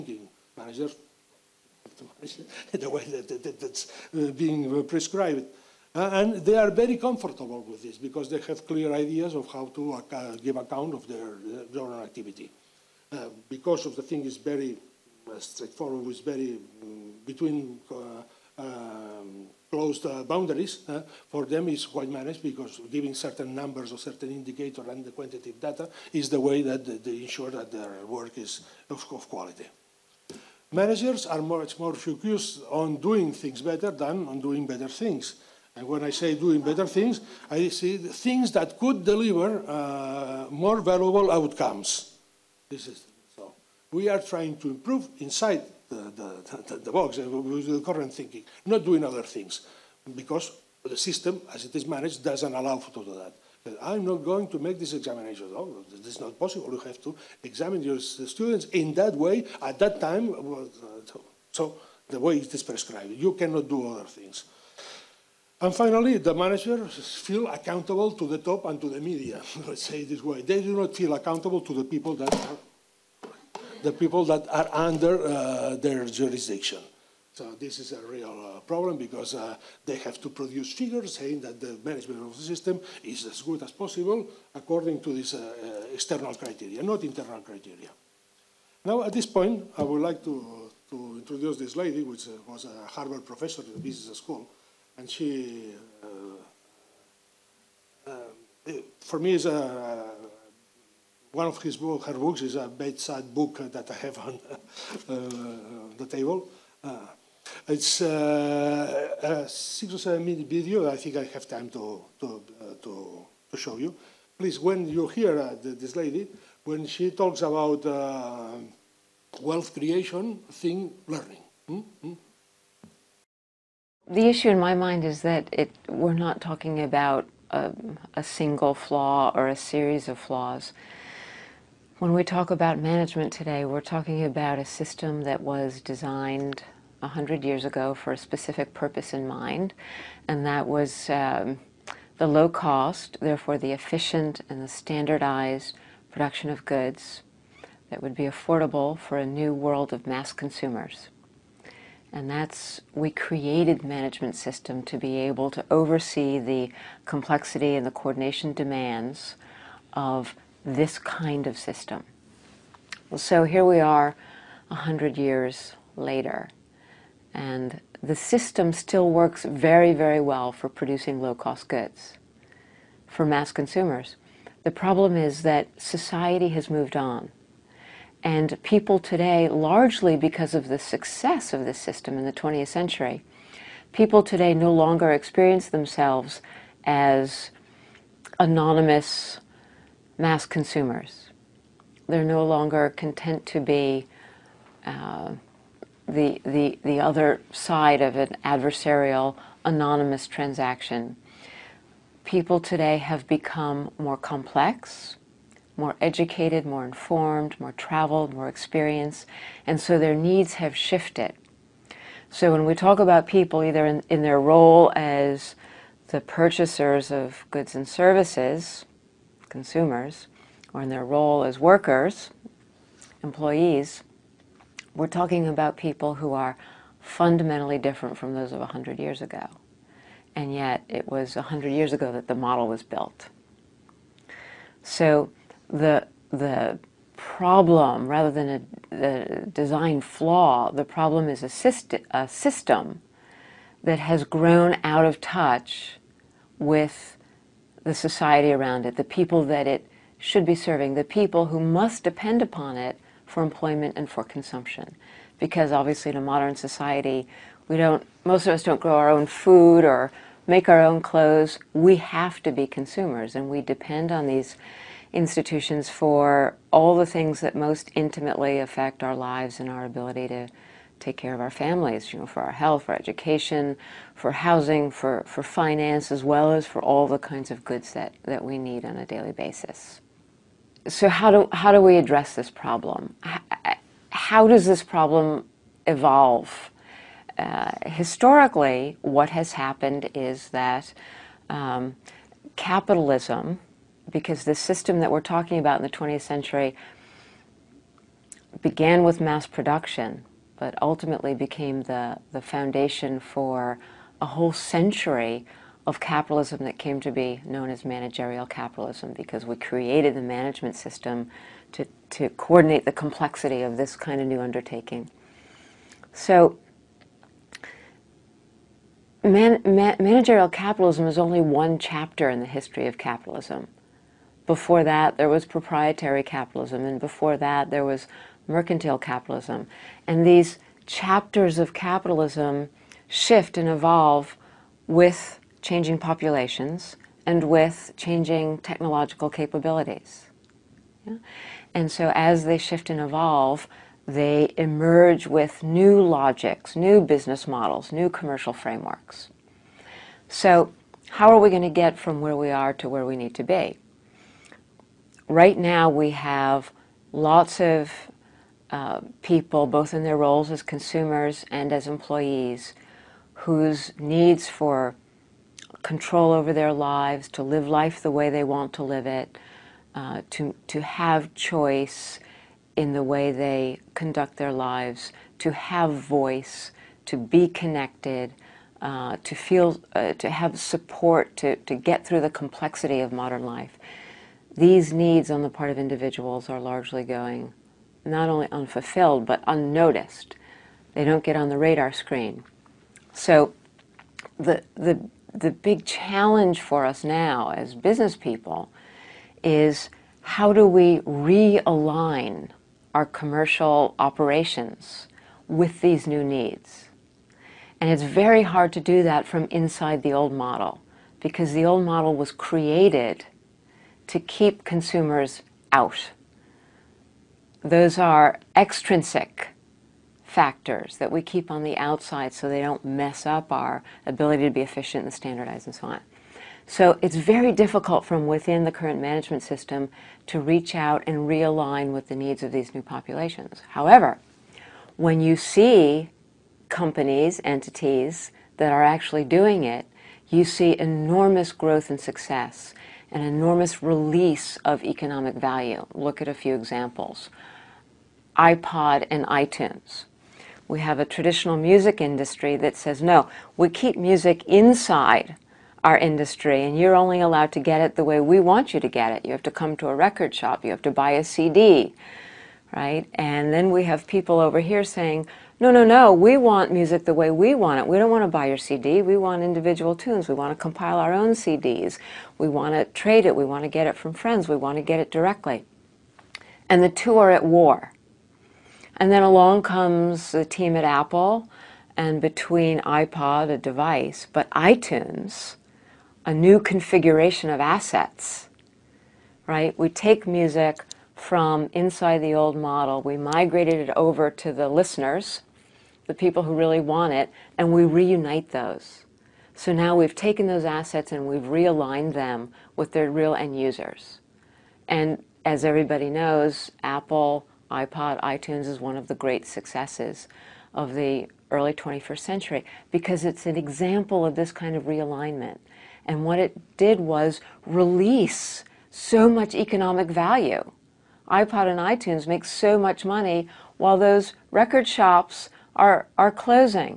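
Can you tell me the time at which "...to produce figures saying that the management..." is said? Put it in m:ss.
1:20.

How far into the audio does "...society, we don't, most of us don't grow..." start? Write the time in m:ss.
4:16.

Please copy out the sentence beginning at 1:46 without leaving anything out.
Uh, it's uh, a six or seven minute video.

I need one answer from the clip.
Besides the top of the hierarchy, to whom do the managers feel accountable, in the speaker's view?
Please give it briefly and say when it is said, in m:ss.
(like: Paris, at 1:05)
the media, at 1:08.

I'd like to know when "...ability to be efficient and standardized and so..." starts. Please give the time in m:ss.
7:04.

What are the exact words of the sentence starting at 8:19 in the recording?
So now we've taken those assets and we've realigned them with their real end users.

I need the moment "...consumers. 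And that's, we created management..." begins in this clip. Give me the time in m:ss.
2:30.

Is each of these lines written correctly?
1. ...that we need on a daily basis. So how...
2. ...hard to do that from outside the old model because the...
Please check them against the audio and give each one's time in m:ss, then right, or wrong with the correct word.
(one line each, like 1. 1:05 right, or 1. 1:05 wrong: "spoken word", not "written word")
1. 4:38 right
2. 6:48 wrong: "inside", not "outside".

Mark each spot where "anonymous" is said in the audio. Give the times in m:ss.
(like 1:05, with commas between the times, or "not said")
3:08, 3:19.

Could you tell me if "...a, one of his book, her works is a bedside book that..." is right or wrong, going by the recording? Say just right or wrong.
wrong.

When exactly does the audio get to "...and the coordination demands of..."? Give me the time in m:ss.
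2:37.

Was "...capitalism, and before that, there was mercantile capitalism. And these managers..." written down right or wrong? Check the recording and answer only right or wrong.
wrong.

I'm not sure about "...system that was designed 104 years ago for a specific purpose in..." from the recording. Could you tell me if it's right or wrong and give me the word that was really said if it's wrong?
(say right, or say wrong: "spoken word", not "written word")
wrong: "100", not "104".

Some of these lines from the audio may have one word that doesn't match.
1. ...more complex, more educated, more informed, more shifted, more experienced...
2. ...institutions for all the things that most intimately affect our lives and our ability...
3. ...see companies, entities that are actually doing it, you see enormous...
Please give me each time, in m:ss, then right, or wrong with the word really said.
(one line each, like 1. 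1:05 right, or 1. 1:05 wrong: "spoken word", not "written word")
1. 3:23 wrong: "traveled", not "shifted"
2. 4:25 right
3. 7:15 right.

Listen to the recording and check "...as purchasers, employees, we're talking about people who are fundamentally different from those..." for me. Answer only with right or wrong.
wrong.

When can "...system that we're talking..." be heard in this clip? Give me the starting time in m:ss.
4:54.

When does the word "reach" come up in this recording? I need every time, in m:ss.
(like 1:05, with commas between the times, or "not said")
7:10.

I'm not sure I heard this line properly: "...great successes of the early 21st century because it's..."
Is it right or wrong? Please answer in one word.
right.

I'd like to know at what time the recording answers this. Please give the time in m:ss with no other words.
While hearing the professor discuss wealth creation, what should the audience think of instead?
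2:00.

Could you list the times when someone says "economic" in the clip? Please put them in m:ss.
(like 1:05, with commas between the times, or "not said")
7:24, 8:39.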